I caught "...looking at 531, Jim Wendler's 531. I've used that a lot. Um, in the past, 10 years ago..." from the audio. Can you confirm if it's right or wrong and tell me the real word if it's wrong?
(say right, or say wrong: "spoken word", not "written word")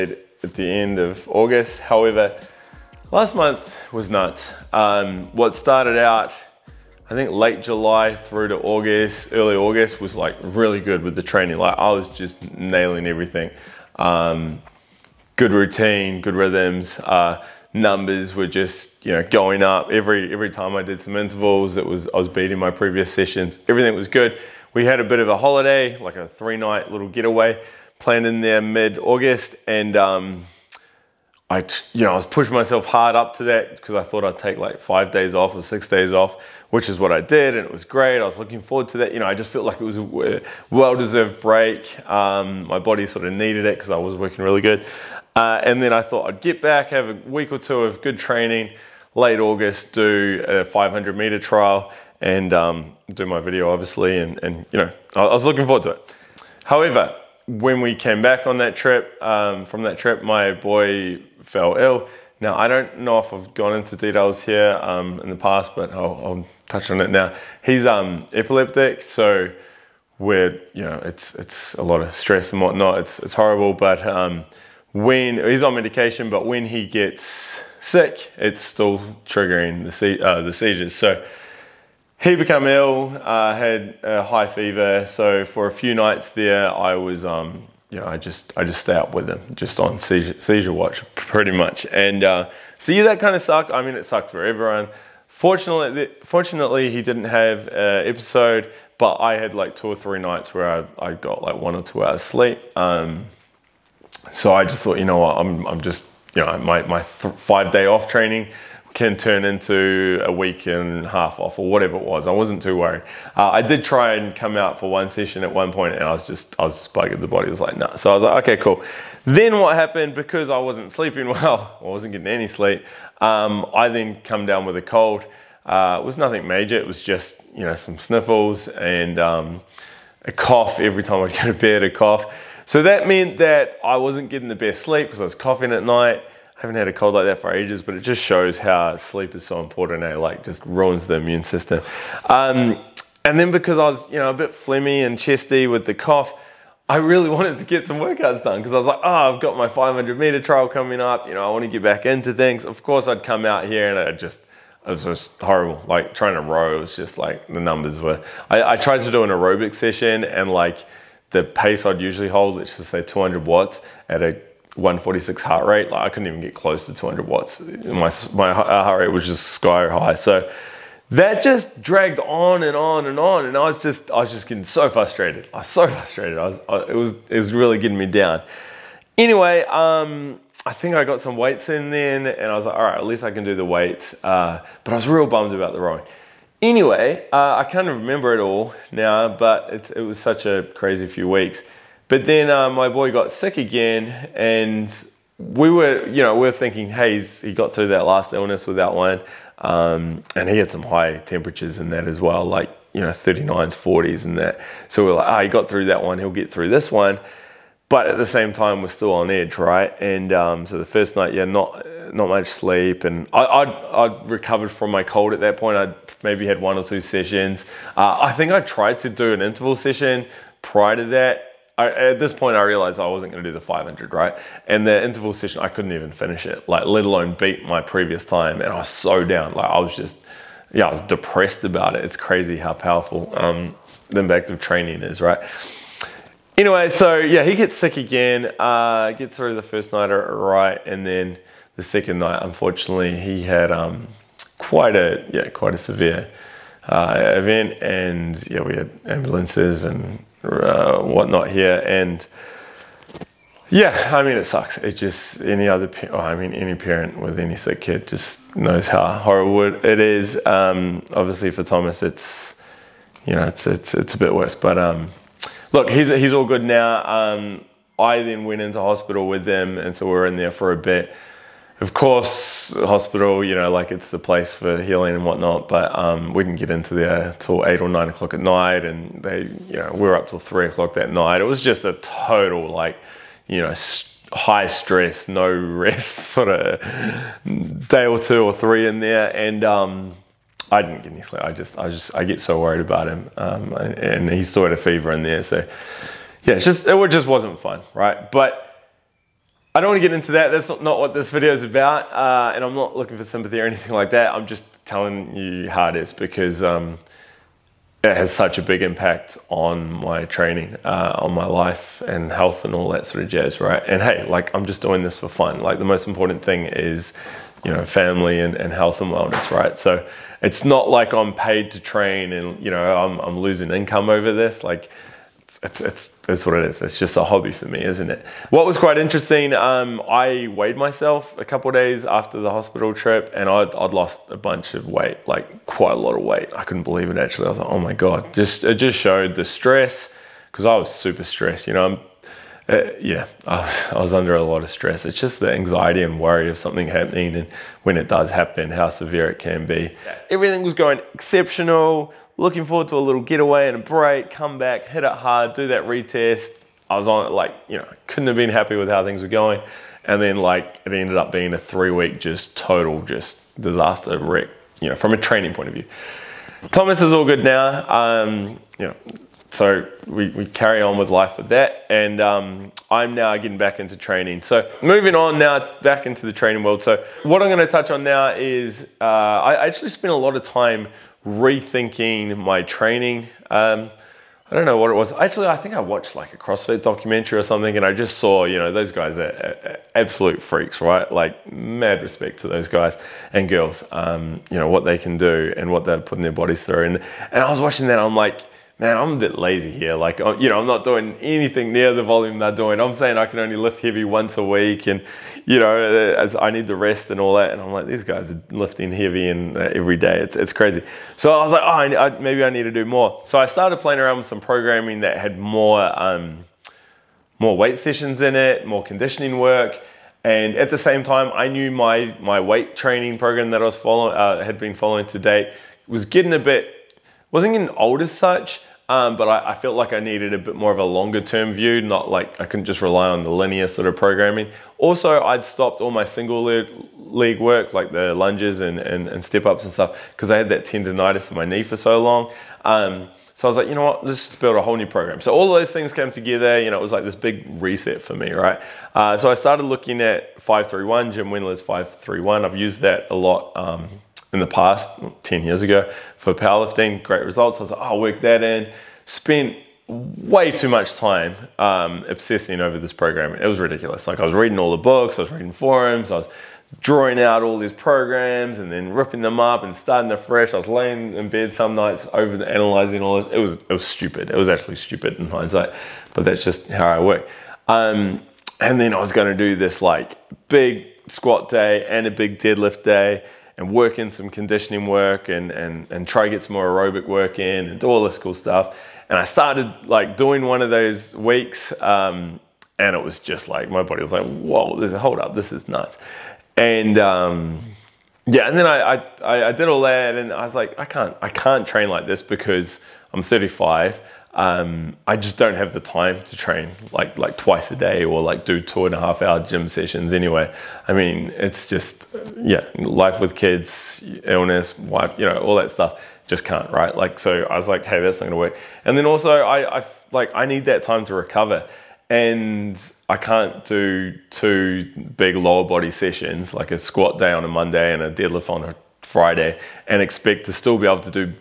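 right.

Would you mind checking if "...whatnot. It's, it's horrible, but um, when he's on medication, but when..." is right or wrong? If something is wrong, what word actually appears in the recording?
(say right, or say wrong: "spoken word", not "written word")
right.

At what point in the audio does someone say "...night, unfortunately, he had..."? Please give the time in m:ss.
4:02.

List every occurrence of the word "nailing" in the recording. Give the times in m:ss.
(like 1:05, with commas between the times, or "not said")
0:12.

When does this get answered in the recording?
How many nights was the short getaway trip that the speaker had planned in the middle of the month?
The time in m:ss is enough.
0:26.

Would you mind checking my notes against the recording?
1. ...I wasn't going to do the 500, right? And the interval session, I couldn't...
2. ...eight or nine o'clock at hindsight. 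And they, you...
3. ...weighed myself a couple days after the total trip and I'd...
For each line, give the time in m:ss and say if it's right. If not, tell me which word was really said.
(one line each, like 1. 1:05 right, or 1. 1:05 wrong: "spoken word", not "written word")
1. 3:42 right
2. 4:37 wrong: "night", not "hindsight"
3. 5:30 wrong: "hospital", not "total".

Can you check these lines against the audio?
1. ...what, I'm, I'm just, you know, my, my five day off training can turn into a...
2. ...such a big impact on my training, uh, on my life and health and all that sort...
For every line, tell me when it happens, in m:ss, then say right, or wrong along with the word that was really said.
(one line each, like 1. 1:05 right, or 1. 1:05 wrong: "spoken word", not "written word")
1. 1:45 right
2. 5:08 right.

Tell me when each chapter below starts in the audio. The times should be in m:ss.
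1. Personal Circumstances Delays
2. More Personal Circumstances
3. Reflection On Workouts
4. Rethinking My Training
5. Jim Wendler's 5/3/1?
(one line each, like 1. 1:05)
1. 0:55
2. 3:05
3. 4:57
4. 6:15
5. 7:28.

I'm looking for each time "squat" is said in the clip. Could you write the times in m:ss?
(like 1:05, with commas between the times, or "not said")
8:01, 8:46.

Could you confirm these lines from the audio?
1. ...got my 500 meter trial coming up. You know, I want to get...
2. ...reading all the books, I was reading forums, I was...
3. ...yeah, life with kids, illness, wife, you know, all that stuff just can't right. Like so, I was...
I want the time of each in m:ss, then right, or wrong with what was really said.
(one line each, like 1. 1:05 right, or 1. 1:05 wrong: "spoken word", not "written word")
1. 2:29 right
2. 7:44 right
3. 8:32 right.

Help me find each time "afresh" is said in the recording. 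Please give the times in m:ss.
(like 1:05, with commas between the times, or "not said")
7:50.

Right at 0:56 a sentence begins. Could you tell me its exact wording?
However, when we came back on that trip, um, from that trip, my boy fell ill.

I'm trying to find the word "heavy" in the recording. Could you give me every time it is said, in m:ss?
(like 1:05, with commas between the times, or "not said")
6:43, 6:48.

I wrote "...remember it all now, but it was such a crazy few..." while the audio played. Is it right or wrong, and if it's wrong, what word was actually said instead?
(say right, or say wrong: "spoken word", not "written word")
right.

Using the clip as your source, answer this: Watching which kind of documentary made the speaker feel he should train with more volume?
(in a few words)
CrossFit.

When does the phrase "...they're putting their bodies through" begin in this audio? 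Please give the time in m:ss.
6:35.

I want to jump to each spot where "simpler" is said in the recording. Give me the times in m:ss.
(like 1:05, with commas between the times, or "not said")
not said.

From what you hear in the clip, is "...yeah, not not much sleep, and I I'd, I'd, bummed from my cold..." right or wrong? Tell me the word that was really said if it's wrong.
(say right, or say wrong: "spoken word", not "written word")
wrong: "recovered", not "bummed".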